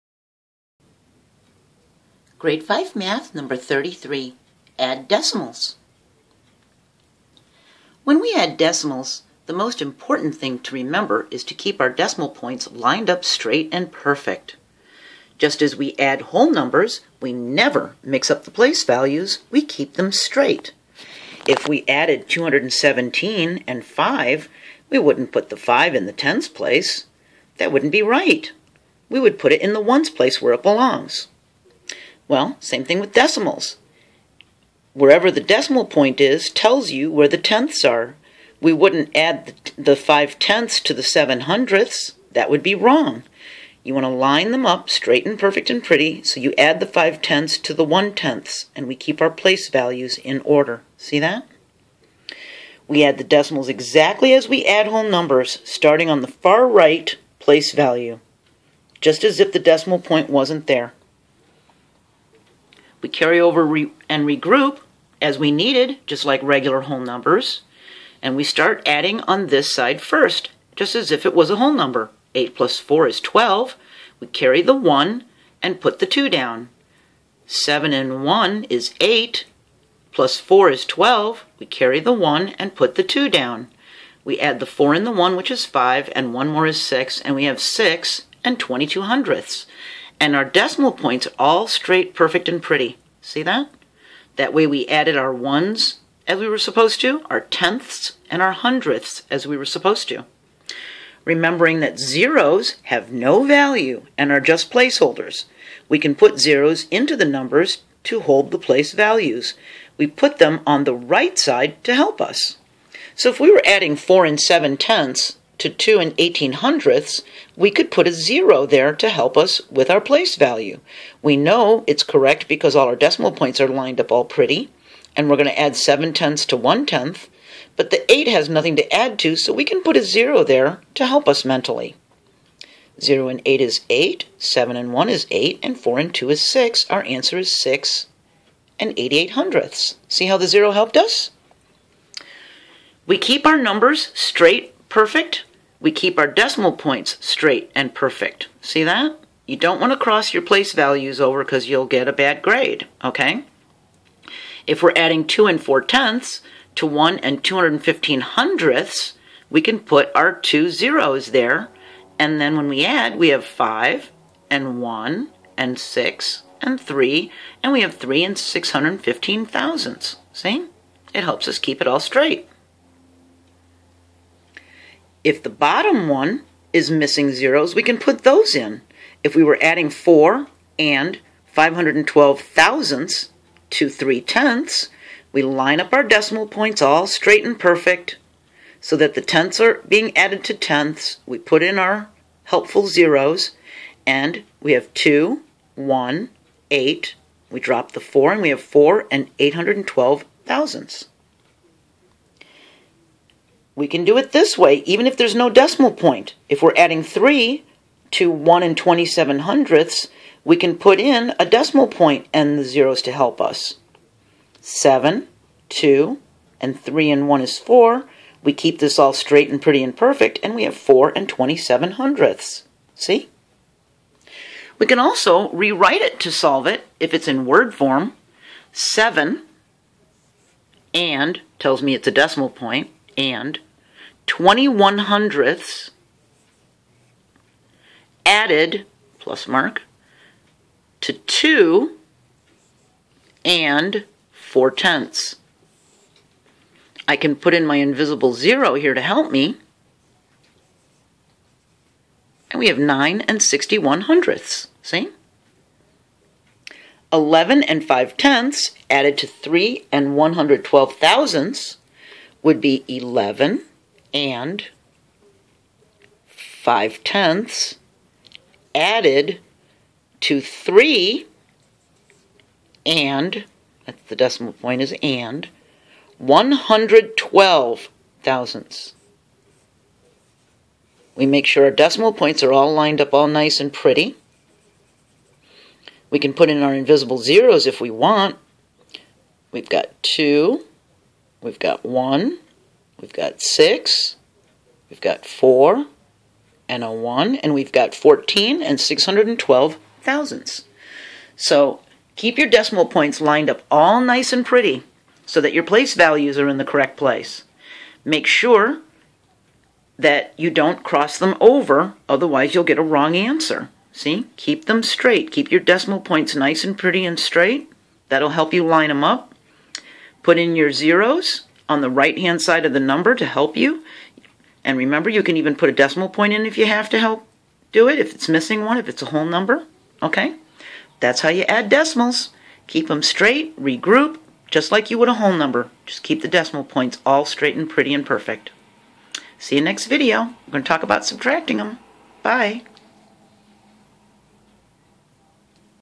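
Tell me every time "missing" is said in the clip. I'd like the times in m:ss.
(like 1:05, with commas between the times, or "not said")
2:56, 5:28.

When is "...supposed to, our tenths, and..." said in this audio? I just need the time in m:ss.
1:36.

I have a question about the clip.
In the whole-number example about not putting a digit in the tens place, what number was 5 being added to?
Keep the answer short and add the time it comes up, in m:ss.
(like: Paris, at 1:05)
217, at 0:22.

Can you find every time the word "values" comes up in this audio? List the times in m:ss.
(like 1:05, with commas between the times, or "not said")
0:18, 0:49, 0:57, 1:43, 1:48, 2:00, 2:30, 5:05.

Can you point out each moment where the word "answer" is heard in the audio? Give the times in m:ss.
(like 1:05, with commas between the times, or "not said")
2:17, 5:13.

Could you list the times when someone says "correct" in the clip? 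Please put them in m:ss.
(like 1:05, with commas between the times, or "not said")
2:02, 5:06.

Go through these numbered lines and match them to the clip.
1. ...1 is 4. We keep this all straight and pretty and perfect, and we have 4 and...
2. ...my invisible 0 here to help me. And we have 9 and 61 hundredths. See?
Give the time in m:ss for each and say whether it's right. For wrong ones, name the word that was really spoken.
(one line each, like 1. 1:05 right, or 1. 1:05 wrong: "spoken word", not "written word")
1. 3:37 right
2. 4:07 right.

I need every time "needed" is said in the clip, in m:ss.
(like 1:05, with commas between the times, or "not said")
1:05.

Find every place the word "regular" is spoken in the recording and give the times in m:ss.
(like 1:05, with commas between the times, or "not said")
1:06.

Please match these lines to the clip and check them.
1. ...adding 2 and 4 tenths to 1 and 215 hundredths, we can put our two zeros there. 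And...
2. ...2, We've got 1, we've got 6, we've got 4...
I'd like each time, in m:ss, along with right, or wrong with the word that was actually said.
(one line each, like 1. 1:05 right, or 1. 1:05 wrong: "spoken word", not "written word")
1. 2:34 right
2. 4:50 right.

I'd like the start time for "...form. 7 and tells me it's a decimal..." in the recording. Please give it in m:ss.
3:47.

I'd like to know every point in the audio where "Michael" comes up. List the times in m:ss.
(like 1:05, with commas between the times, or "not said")
not said.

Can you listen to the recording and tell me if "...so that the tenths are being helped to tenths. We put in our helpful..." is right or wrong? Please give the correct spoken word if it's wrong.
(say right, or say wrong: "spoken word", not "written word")
wrong: "added", not "helped".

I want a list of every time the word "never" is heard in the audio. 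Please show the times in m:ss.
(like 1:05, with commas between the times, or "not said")
0:17.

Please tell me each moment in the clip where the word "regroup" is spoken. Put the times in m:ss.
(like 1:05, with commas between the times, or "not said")
1:04, 5:33.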